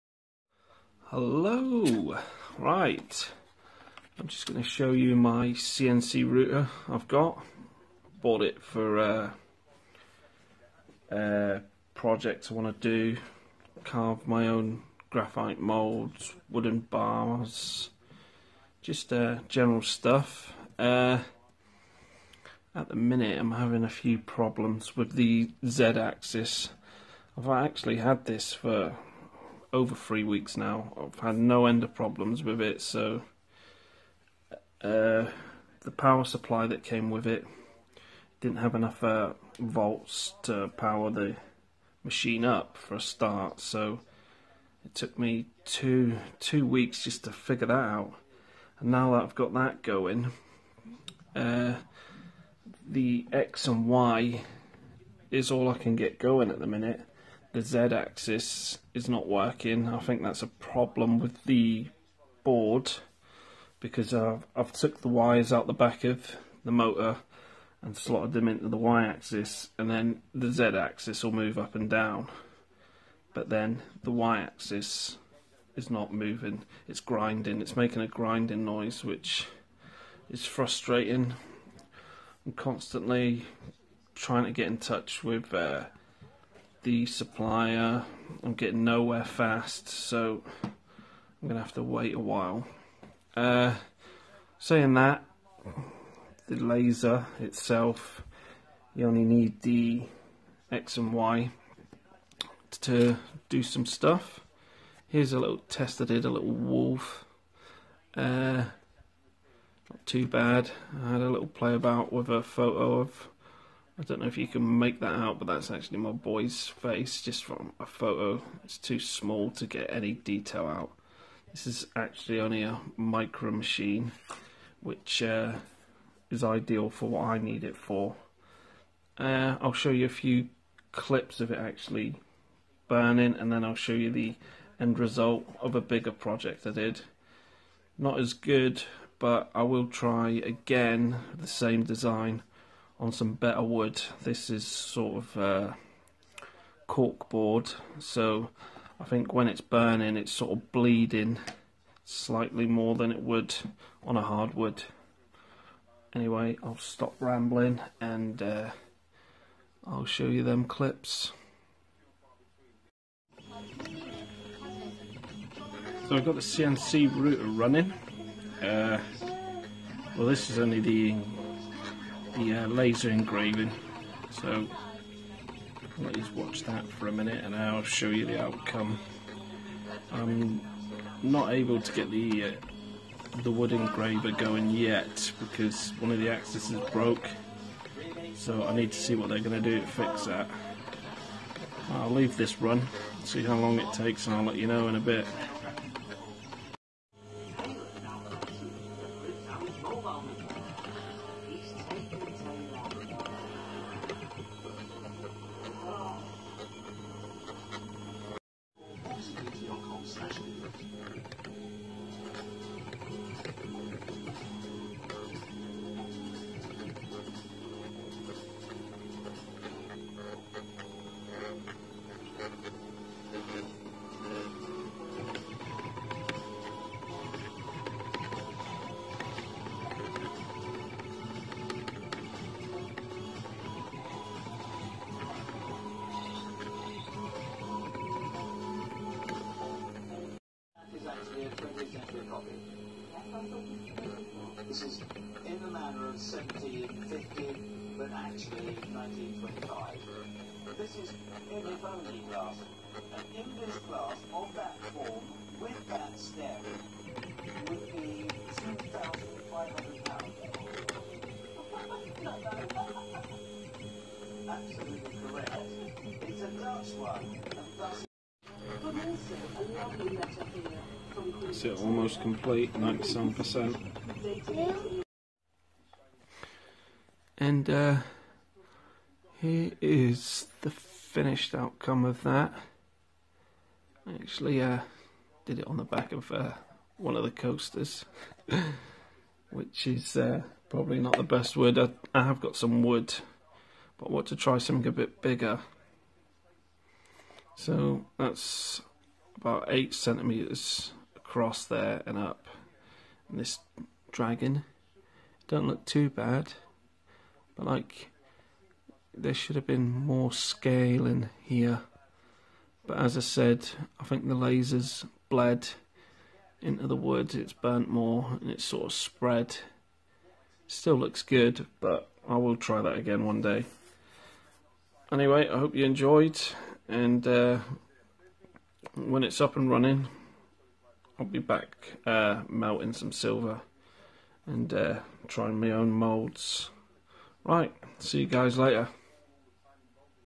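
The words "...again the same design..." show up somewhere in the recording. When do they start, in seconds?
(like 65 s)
140 s.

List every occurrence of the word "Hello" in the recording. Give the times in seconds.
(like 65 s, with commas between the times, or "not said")
1 s.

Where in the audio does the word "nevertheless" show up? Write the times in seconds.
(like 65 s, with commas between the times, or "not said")
not said.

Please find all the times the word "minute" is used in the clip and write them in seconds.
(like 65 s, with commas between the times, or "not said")
22 s, 56 s, 177 s.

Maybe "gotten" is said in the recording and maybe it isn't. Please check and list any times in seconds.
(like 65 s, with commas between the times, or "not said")
not said.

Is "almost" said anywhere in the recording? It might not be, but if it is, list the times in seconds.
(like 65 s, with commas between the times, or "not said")
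271 s.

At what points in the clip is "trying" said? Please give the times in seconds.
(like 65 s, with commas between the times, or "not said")
84 s, 335 s.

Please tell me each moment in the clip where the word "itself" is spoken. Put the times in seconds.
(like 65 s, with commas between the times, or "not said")
97 s.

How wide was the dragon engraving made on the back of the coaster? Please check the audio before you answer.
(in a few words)
8 centimetres.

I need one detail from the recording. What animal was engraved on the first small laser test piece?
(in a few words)
wolf.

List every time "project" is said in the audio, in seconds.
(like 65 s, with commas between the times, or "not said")
11 s, 136 s.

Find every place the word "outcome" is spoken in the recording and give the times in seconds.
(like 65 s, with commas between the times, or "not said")
178 s, 281 s.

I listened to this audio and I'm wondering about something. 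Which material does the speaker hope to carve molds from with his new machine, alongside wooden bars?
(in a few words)
graphite.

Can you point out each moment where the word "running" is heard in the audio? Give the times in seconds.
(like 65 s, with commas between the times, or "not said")
167 s, 329 s.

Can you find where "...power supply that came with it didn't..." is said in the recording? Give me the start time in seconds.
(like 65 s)
35 s.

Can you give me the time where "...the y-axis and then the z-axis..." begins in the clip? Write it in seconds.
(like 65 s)
68 s.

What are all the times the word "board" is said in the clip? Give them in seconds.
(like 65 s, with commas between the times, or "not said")
62 s, 147 s.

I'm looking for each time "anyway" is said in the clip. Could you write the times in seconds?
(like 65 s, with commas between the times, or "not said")
156 s, 325 s.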